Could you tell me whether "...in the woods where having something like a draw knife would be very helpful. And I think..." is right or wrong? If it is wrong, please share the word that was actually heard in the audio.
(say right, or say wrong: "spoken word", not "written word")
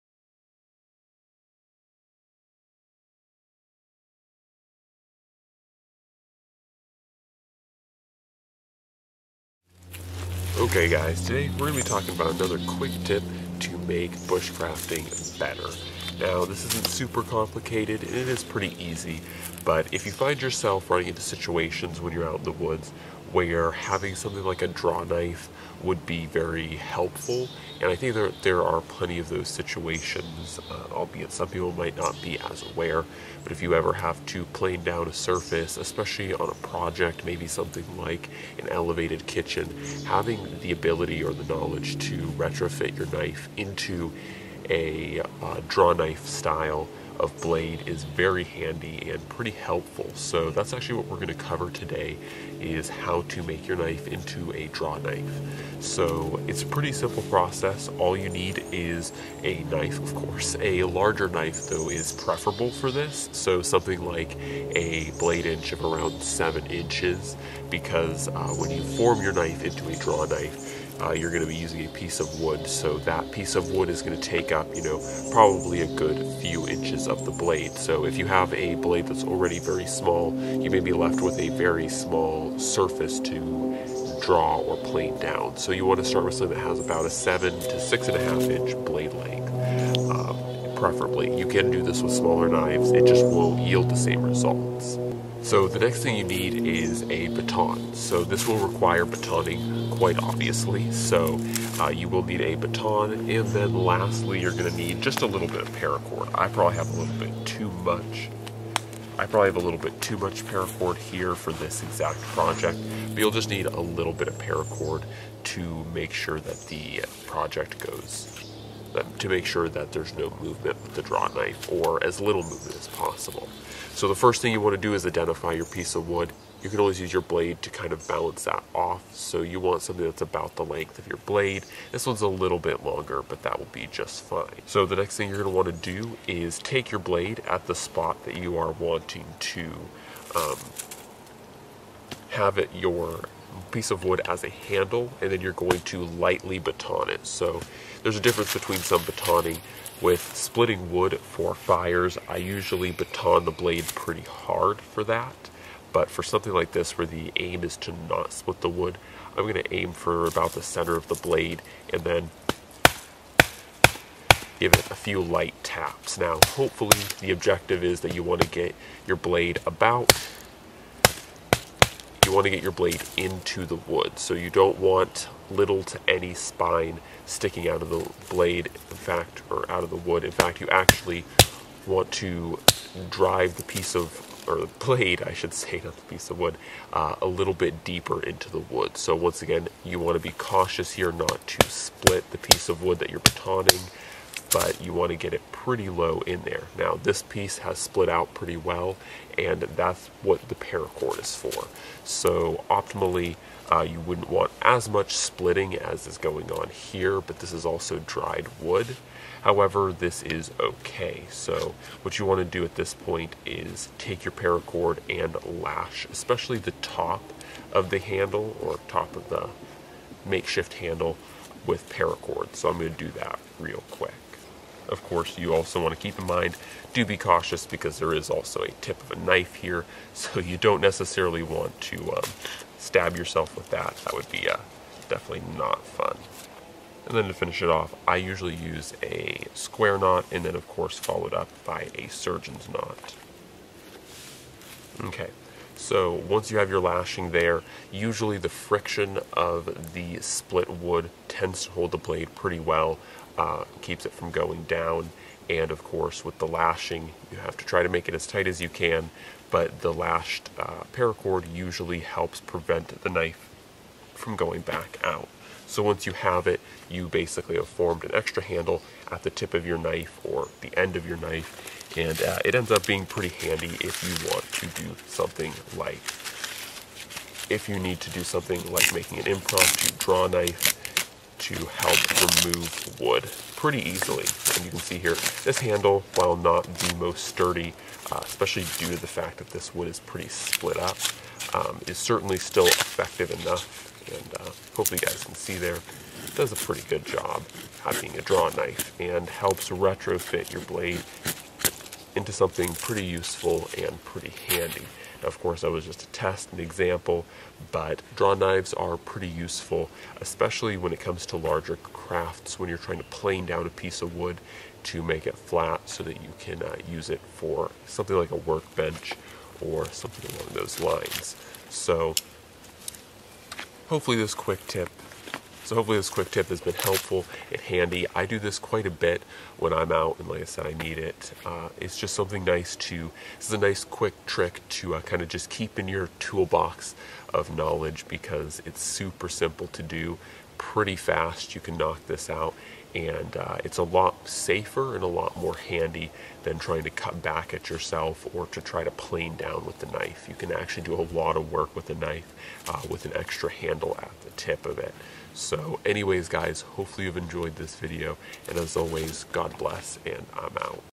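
right.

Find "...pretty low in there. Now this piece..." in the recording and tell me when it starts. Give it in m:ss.
3:15.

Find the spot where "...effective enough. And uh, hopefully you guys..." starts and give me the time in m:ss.
4:52.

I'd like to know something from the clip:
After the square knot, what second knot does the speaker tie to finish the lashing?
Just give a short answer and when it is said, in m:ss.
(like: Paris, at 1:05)
surgeon's knot, at 4:02.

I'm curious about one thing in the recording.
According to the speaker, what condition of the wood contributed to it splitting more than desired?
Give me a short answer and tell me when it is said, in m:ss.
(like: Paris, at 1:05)
dried wood, at 3:28.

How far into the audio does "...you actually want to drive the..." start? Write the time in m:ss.
3:00.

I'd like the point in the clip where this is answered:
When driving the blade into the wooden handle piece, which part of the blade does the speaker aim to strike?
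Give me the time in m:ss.
2:40.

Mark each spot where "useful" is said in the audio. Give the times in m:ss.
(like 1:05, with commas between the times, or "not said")
5:03, 5:09.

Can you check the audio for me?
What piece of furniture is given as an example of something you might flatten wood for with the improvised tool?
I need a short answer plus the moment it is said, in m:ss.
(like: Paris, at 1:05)
workbench, at 5:18.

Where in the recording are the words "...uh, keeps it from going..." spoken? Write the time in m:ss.
4:13.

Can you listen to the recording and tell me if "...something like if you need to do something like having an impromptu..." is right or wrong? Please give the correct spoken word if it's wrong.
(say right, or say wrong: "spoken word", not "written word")
wrong: "making", not "having".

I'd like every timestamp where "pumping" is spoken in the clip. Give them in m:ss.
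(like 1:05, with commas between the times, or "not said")
not said.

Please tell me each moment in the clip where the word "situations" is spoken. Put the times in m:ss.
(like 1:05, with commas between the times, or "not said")
0:21, 0:29.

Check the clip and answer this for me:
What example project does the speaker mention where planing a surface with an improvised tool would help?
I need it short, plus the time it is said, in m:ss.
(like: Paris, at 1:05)
elevated kitchen, at 0:38.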